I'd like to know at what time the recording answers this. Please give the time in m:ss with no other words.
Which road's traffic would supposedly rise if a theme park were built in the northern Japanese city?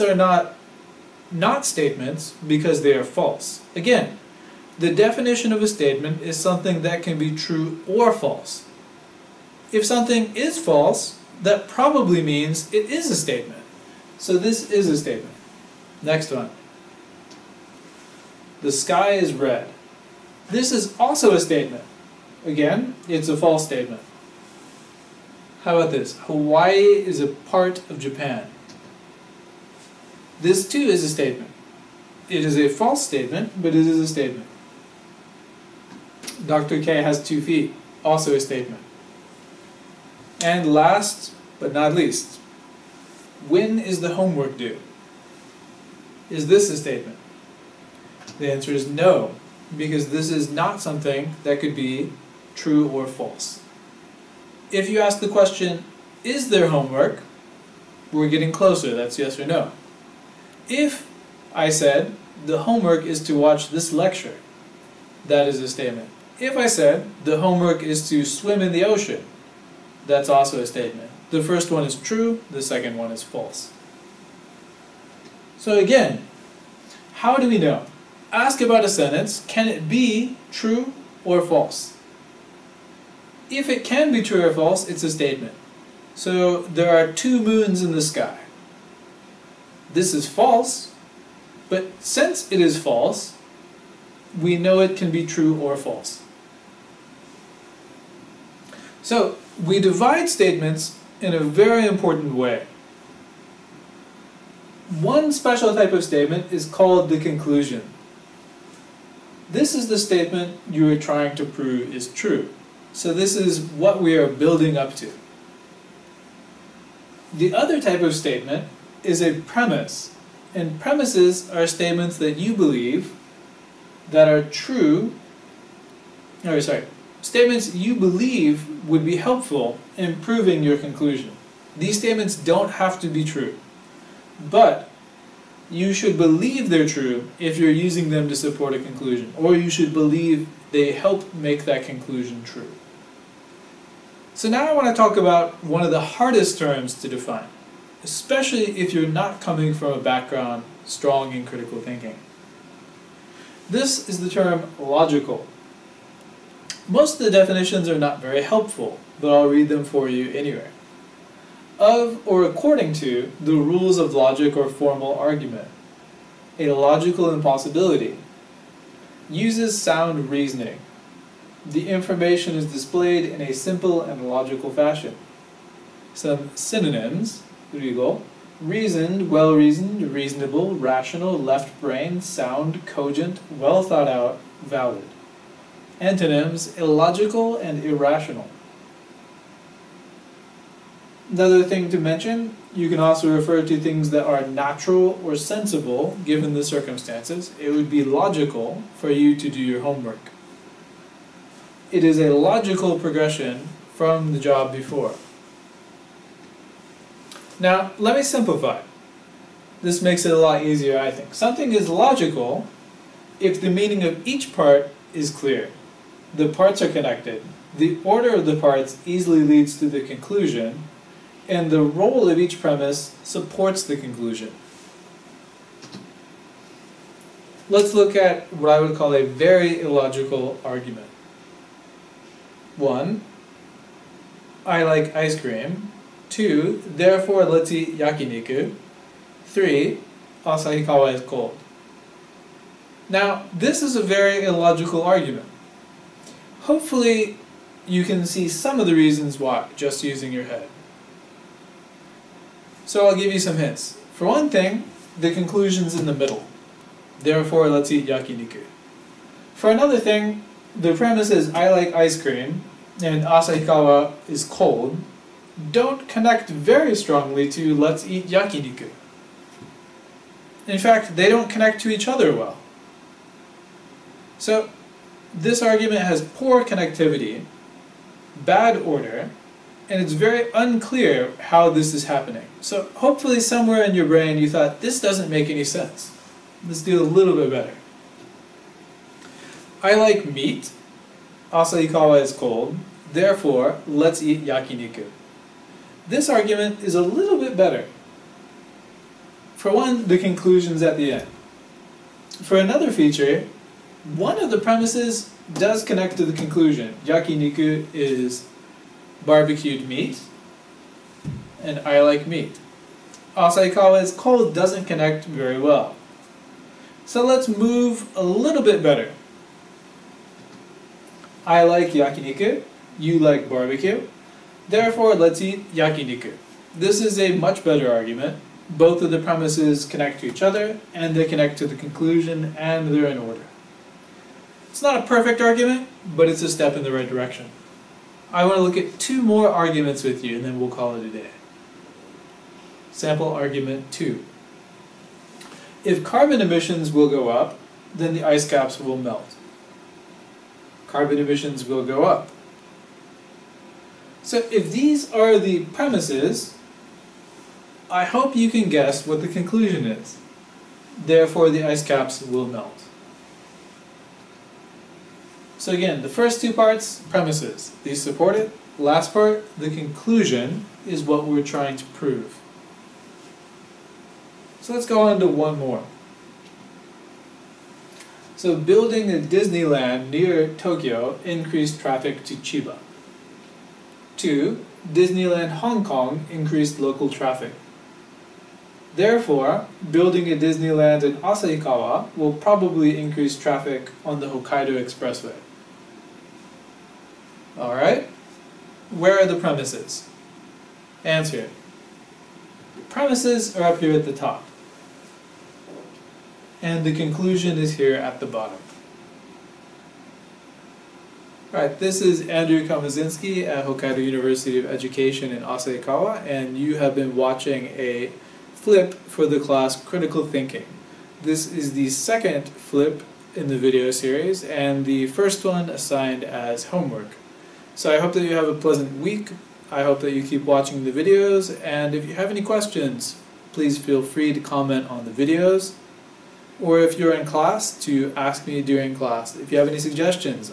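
6:34.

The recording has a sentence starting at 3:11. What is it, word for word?
Another thing to mention, you can also refer to things that are natural or sensible given the circumstances.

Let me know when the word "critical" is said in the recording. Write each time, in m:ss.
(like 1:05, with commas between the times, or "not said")
2:31, 6:59.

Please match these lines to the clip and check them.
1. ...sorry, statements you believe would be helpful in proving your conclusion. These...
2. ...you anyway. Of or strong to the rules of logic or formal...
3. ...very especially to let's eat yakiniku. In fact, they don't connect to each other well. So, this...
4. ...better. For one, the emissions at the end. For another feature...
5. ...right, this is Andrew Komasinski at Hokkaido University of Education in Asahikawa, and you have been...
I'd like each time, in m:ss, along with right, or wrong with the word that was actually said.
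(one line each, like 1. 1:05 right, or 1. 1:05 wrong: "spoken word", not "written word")
1. 2:06 right
2. 2:40 wrong: "according", not "strong"
3. 4:26 wrong: "strongly", not "especially"
4. 4:57 wrong: "conclusions", not "emissions"
5. 6:51 right.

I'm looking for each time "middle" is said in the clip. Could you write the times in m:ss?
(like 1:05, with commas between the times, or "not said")
4:16.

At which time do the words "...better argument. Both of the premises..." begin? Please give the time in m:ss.
5:27.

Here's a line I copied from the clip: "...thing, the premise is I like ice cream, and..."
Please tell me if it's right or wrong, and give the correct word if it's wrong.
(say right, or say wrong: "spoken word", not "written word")
right.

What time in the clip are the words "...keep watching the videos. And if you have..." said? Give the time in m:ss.
7:10.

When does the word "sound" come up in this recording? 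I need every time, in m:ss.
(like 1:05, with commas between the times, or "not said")
2:49, 3:02.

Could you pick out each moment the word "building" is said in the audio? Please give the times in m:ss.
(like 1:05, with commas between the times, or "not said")
1:54, 6:18, 6:29.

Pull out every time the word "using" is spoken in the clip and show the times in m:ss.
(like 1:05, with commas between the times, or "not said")
2:17, 4:10.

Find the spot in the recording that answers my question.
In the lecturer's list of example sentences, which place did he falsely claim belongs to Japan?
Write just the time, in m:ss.
0:26.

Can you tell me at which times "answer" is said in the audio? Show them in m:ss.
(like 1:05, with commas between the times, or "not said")
0:48, 6:41.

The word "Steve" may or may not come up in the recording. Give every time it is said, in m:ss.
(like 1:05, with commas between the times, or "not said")
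not said.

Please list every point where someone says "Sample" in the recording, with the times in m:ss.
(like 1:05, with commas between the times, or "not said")
5:42.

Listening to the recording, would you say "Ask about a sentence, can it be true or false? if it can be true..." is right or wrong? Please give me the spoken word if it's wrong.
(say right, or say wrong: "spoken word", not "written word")
right.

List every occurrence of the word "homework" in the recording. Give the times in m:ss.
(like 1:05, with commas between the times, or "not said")
0:44, 0:56, 1:02, 1:07, 3:19, 7:06.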